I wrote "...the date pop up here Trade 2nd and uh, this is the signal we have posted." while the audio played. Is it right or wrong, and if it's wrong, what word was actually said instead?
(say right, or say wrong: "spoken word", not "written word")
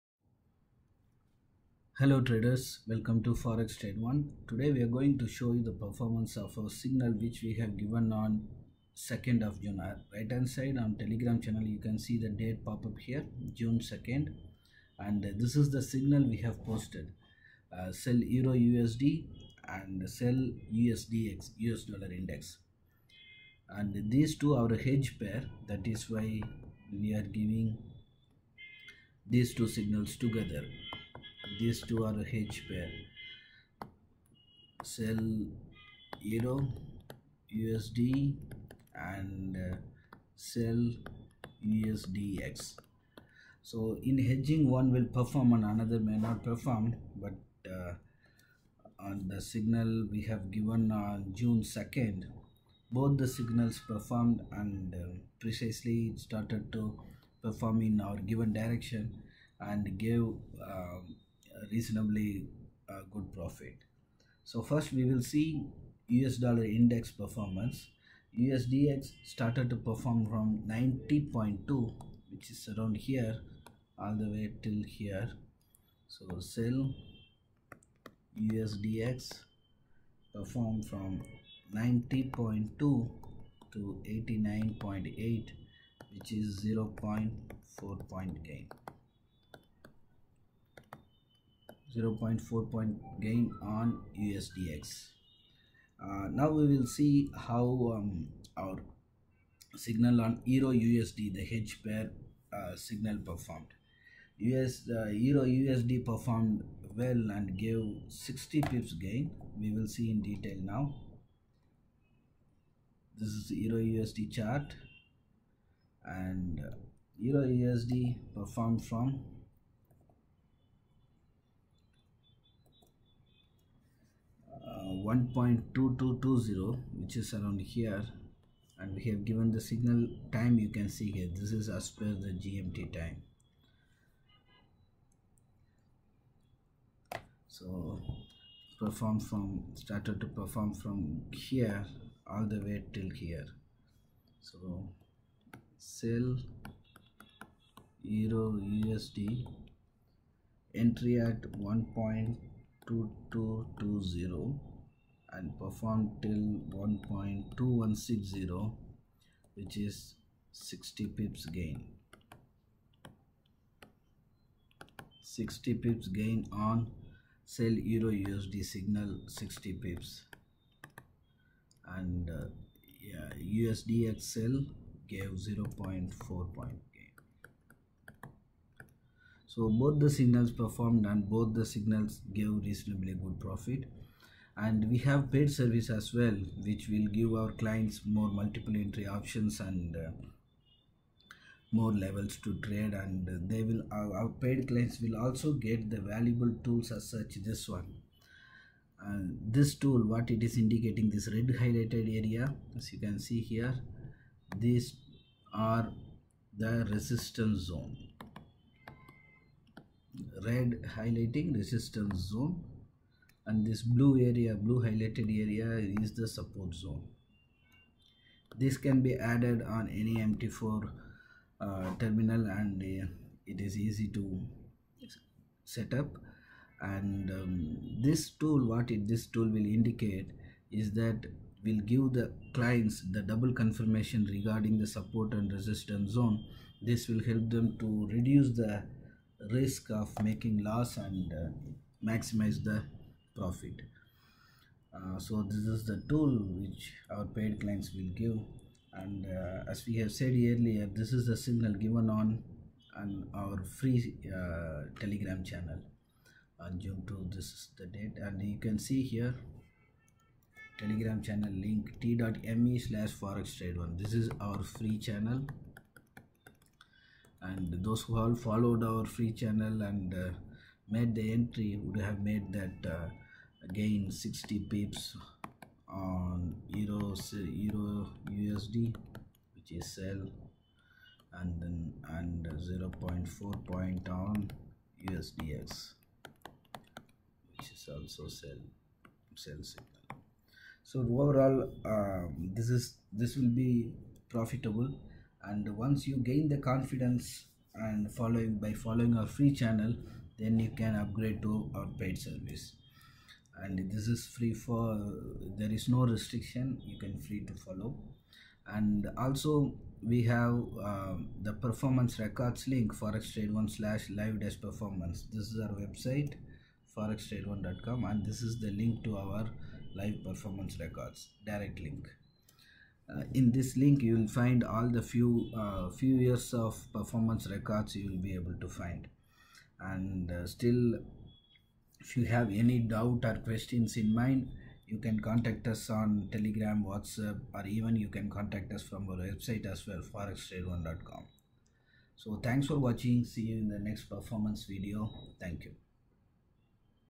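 wrong: "June", not "Trade".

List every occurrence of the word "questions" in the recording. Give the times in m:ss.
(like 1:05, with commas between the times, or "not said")
5:33.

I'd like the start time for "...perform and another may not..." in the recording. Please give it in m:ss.
0:45.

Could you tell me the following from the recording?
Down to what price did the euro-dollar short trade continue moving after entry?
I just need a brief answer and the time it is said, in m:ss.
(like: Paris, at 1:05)
1.2160, at 2:35.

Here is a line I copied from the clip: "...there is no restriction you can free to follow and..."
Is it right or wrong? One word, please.
right.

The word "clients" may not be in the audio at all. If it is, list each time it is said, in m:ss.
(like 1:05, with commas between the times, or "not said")
3:07, 3:14, 3:52, 4:07.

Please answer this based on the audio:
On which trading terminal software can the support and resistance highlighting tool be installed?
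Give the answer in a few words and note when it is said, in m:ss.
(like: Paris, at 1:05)
MT4, at 3:40.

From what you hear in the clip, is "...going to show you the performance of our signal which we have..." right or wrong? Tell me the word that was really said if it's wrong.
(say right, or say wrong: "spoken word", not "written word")
right.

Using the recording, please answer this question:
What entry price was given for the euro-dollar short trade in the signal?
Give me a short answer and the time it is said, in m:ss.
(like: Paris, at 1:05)
1.2220, at 2:30.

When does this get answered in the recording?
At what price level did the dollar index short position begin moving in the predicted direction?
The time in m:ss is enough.
1:08.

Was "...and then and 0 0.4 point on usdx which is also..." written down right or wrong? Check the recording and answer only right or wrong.
right.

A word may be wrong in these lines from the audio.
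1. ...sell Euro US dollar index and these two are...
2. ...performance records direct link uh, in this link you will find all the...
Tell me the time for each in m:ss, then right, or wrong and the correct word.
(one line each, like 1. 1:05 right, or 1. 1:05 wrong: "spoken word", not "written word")
1. 0:20 wrong: "USDX", not "Euro"
2. 5:20 right.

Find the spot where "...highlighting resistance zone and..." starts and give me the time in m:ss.
3:30.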